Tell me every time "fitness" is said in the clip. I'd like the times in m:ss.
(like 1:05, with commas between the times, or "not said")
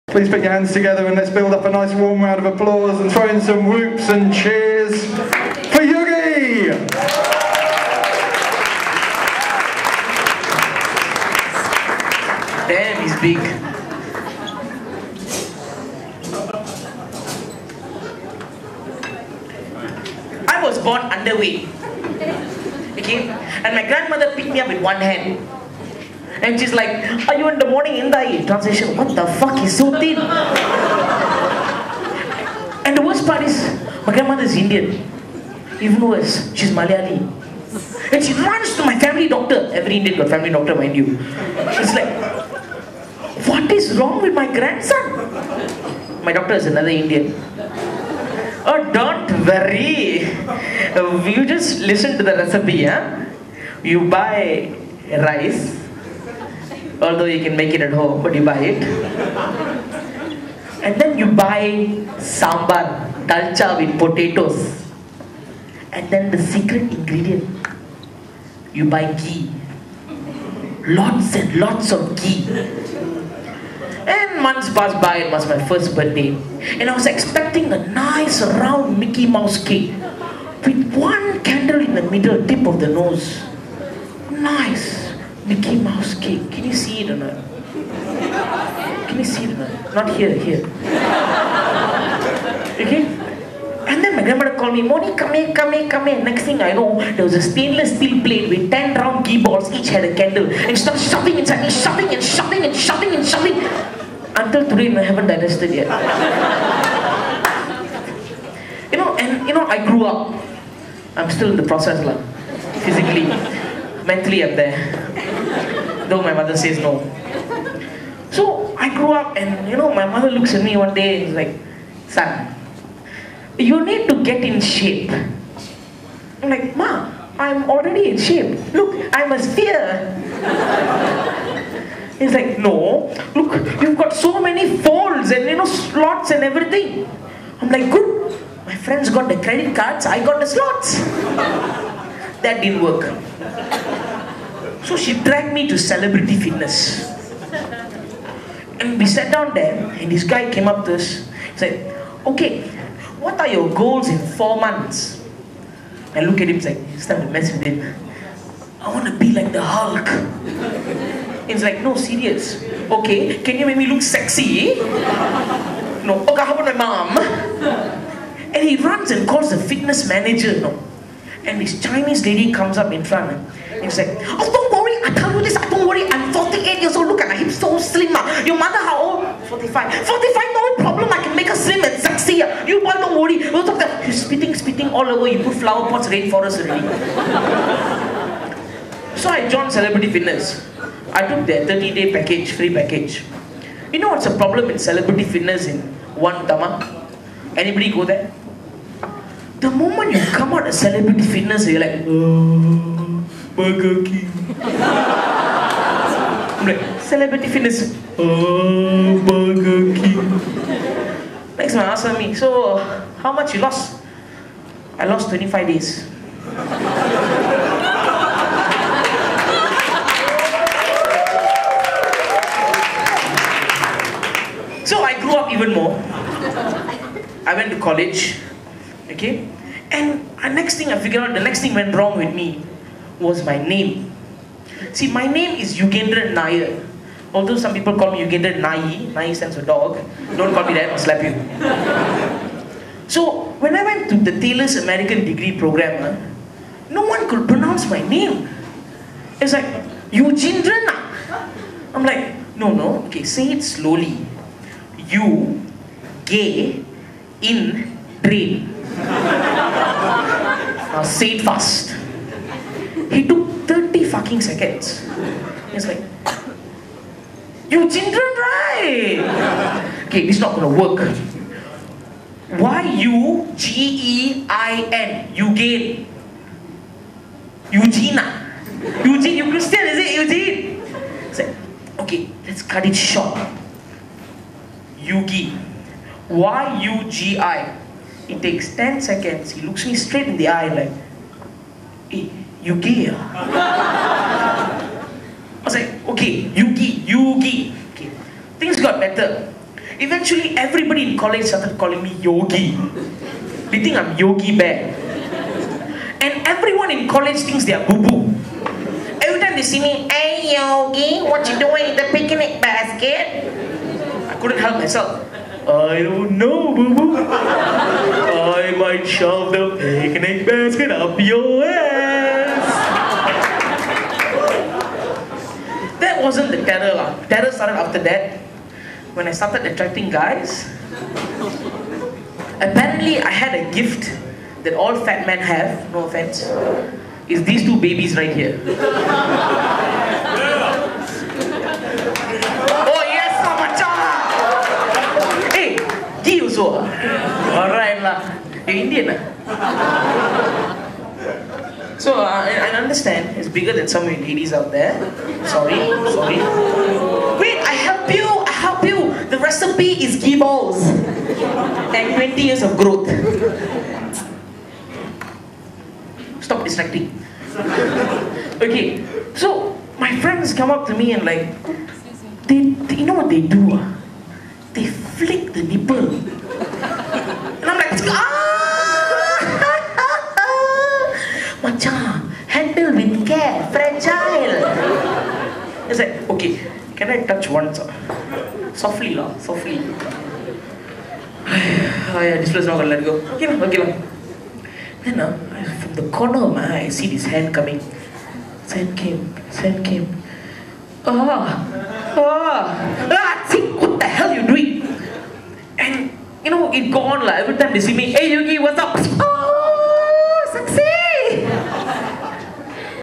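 2:26, 2:49, 3:10, 3:15, 3:21, 3:27.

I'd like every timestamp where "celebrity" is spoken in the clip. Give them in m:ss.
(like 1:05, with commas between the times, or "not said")
2:25, 3:09, 3:14, 3:20, 3:27.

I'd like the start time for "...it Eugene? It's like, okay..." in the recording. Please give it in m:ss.
4:39.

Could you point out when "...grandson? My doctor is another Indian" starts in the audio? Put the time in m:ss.
0:44.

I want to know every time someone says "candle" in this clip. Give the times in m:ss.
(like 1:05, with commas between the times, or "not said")
1:21, 1:40.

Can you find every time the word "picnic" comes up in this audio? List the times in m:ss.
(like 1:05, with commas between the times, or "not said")
5:12, 5:19.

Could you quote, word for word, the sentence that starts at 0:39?
Every Indian got family doctor, mind you.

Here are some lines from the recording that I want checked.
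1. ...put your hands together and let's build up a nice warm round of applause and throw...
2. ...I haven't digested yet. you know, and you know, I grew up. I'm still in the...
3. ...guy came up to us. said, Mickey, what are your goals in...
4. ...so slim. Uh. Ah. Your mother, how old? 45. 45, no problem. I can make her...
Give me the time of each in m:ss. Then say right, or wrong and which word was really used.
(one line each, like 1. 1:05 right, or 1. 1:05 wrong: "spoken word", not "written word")
1. 0:00 right
2. 1:44 right
3. 2:30 wrong: "Okay", not "Mickey"
4. 2:57 right.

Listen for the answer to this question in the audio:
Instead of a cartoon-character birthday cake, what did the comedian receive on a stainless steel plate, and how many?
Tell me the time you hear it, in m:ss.
1:38.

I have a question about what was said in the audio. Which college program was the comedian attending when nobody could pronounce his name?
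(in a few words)
Taylor's American degree program.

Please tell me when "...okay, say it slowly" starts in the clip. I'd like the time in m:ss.
4:13.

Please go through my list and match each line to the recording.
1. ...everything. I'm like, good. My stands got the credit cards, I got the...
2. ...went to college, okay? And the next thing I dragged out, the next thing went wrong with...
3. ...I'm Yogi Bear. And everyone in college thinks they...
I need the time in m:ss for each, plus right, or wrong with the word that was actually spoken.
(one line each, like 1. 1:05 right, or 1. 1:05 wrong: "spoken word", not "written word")
1. 2:16 wrong: "friends", not "stands"
2. 3:47 wrong: "figured", not "dragged"
3. 5:03 right.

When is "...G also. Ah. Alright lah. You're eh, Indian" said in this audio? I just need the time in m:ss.
5:46.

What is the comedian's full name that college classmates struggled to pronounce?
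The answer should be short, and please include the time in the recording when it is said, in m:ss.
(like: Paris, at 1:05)
Yugendra Nair, at 3:55.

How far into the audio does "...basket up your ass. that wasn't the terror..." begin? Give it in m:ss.
5:20.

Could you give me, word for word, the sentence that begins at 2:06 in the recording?
I'm like, ma, I'm already in shape.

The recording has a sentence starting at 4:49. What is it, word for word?
He looks me straight in the eye like, hey, eh, okay, Yuki, Yuki.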